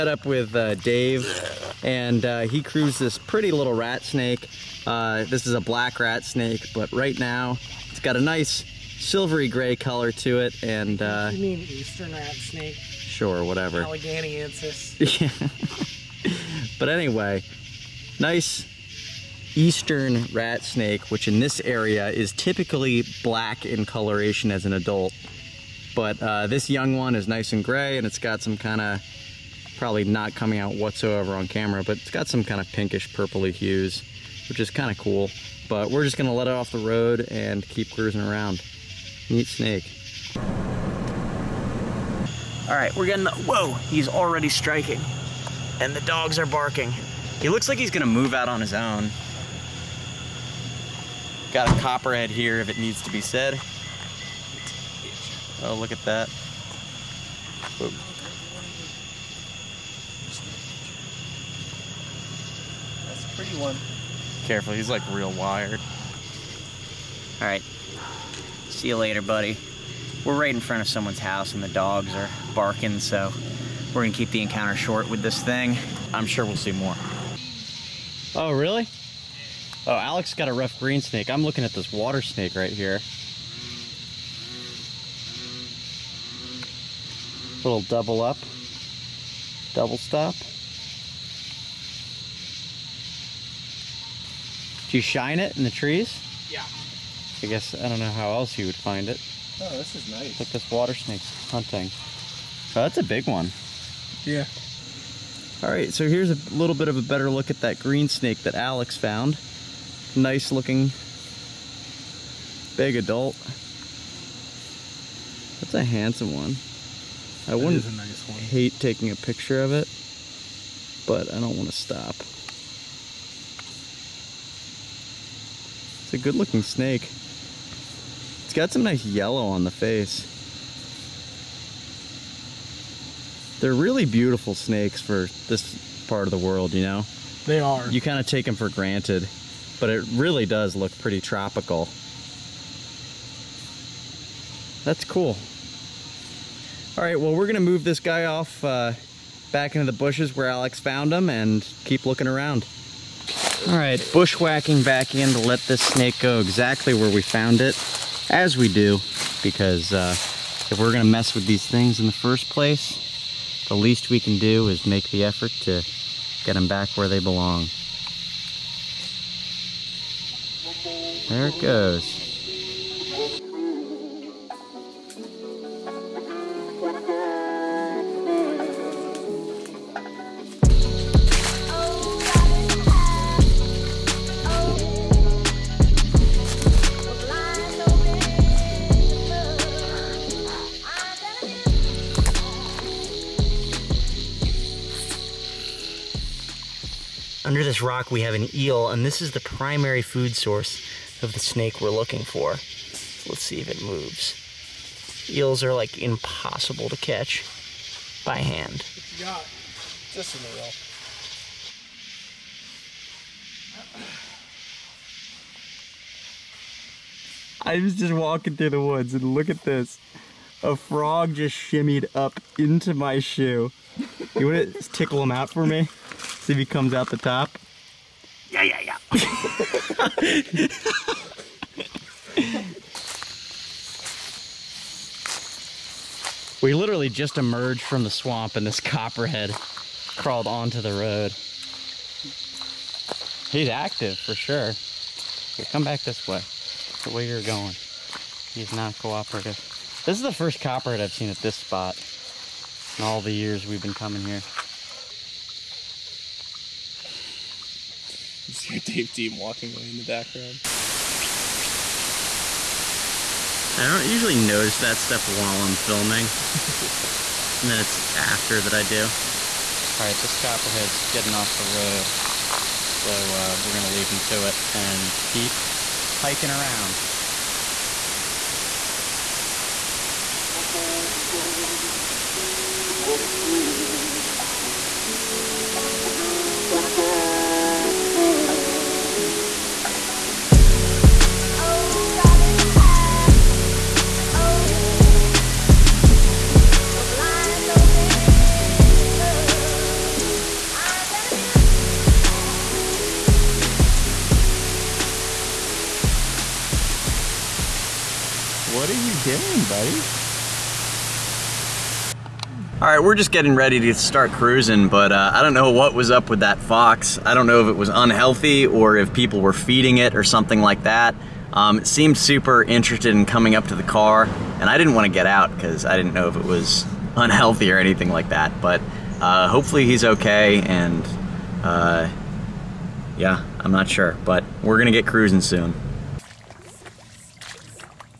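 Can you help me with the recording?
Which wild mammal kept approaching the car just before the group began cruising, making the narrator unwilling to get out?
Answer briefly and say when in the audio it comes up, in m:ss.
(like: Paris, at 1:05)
fox, at 5:16.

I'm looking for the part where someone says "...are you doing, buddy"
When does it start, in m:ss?
5:08.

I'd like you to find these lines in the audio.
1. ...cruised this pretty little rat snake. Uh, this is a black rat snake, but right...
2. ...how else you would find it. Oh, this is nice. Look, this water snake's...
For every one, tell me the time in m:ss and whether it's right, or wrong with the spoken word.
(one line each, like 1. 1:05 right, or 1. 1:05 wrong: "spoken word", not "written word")
1. 0:02 right
2. 1:38 right.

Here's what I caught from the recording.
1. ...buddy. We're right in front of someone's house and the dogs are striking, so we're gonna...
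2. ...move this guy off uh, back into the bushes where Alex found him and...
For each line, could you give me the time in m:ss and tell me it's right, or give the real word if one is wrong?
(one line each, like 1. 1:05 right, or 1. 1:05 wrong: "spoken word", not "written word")
1. 1:09 wrong: "barking", not "striking"
2. 2:27 right.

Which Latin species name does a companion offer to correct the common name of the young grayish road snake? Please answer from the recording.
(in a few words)
Alleghaniensis.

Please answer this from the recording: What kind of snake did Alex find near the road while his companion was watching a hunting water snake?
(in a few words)
rough green snake.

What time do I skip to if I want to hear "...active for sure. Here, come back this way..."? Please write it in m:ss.
4:03.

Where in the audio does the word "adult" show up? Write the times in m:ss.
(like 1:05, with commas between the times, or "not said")
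0:24, 1:52.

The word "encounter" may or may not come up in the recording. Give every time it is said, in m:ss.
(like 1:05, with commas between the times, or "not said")
1:14.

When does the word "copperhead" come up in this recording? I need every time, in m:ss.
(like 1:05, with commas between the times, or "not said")
0:51, 3:58, 4:10, 4:30.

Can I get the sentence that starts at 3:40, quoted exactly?
A frog just shimmied up into my shoe.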